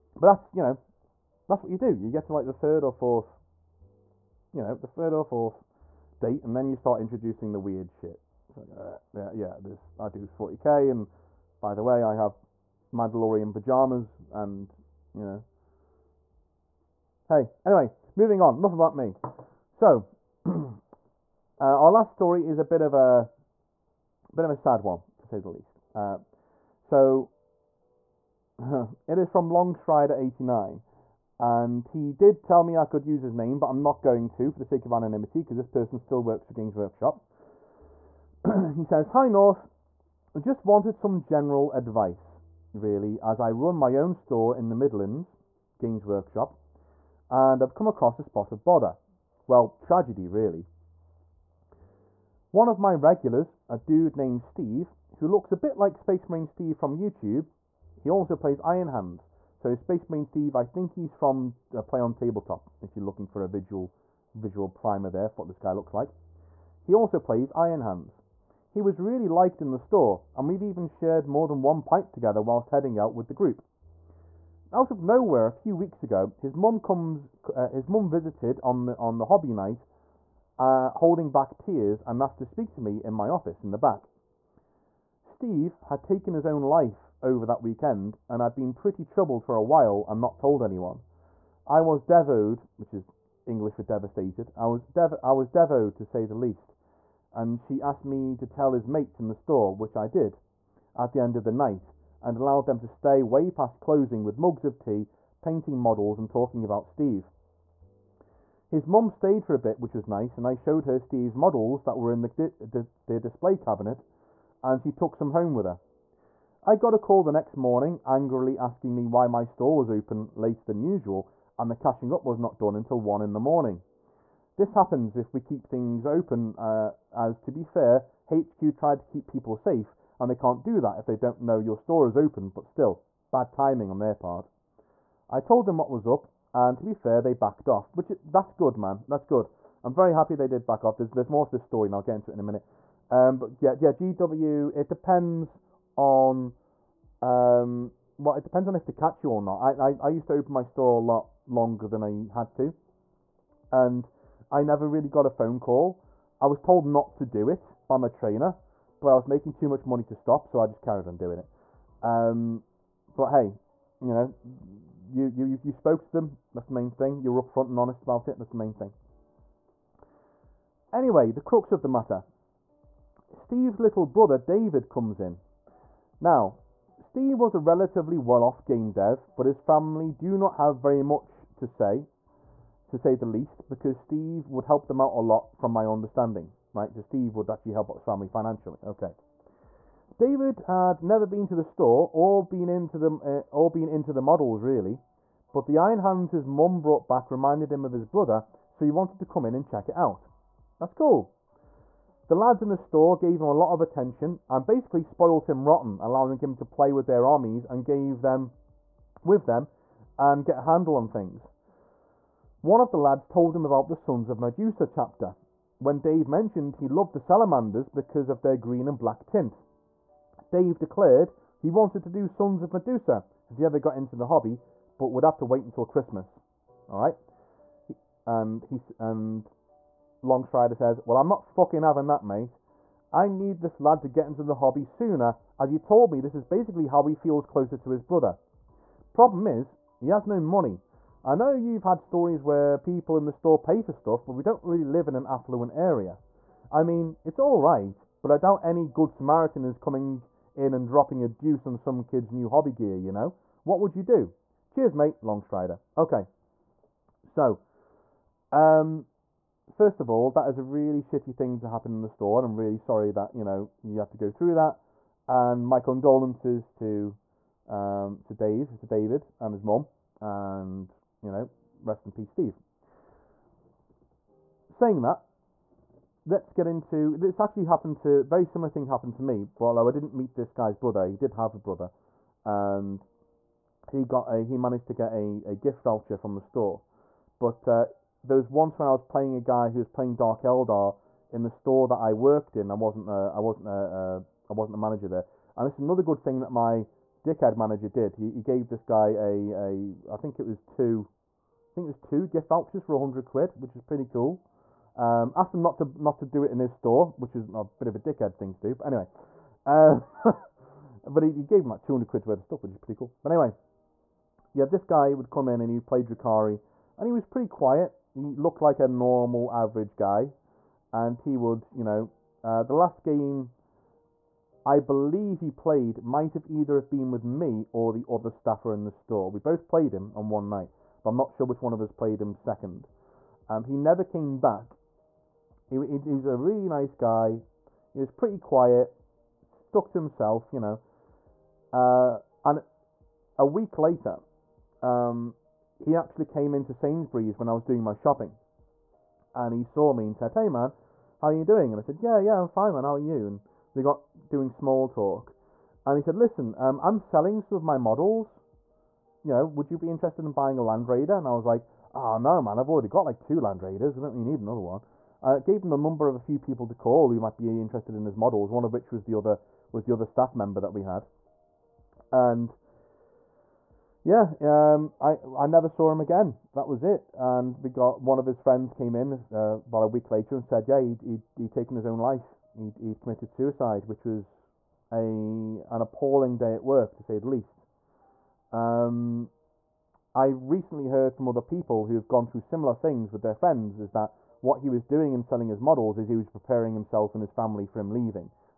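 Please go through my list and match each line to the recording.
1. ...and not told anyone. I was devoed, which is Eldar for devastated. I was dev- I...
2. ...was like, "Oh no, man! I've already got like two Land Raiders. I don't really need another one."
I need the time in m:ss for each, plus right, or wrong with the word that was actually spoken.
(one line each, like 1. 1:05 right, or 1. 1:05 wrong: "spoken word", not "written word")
1. 1:30 wrong: "English", not "Eldar"
2. 6:01 right.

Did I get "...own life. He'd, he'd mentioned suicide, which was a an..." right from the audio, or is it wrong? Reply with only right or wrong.
wrong.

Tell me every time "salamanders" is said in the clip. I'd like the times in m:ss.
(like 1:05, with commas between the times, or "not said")
3:37.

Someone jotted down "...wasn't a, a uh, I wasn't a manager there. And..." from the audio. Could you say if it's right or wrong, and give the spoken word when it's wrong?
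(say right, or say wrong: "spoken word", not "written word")
right.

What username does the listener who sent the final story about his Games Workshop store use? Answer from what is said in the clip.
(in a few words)
Longstrider89.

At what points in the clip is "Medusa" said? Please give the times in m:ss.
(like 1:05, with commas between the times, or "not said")
3:34, 3:42.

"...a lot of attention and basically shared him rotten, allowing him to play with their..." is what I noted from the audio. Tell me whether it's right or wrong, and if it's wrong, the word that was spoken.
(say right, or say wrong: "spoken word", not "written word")
wrong: "spoiled", not "shared".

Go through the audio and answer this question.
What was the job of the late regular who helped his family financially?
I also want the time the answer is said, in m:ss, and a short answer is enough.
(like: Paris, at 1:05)
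game dev, at 2:58.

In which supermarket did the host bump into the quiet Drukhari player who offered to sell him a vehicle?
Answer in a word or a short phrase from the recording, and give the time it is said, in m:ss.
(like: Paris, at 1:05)
Sainsbury's, at 5:46.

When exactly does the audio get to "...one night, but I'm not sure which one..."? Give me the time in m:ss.
5:30.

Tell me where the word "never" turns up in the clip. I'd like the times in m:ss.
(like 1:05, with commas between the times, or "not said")
2:34, 3:11, 5:33, 6:15.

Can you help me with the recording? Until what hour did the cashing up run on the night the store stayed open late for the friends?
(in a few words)
1 in the morning.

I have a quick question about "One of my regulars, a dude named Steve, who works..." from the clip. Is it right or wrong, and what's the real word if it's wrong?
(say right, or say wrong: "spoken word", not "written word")
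wrong: "looks", not "works".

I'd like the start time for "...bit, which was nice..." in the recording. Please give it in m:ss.
1:49.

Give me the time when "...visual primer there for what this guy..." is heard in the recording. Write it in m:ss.
1:04.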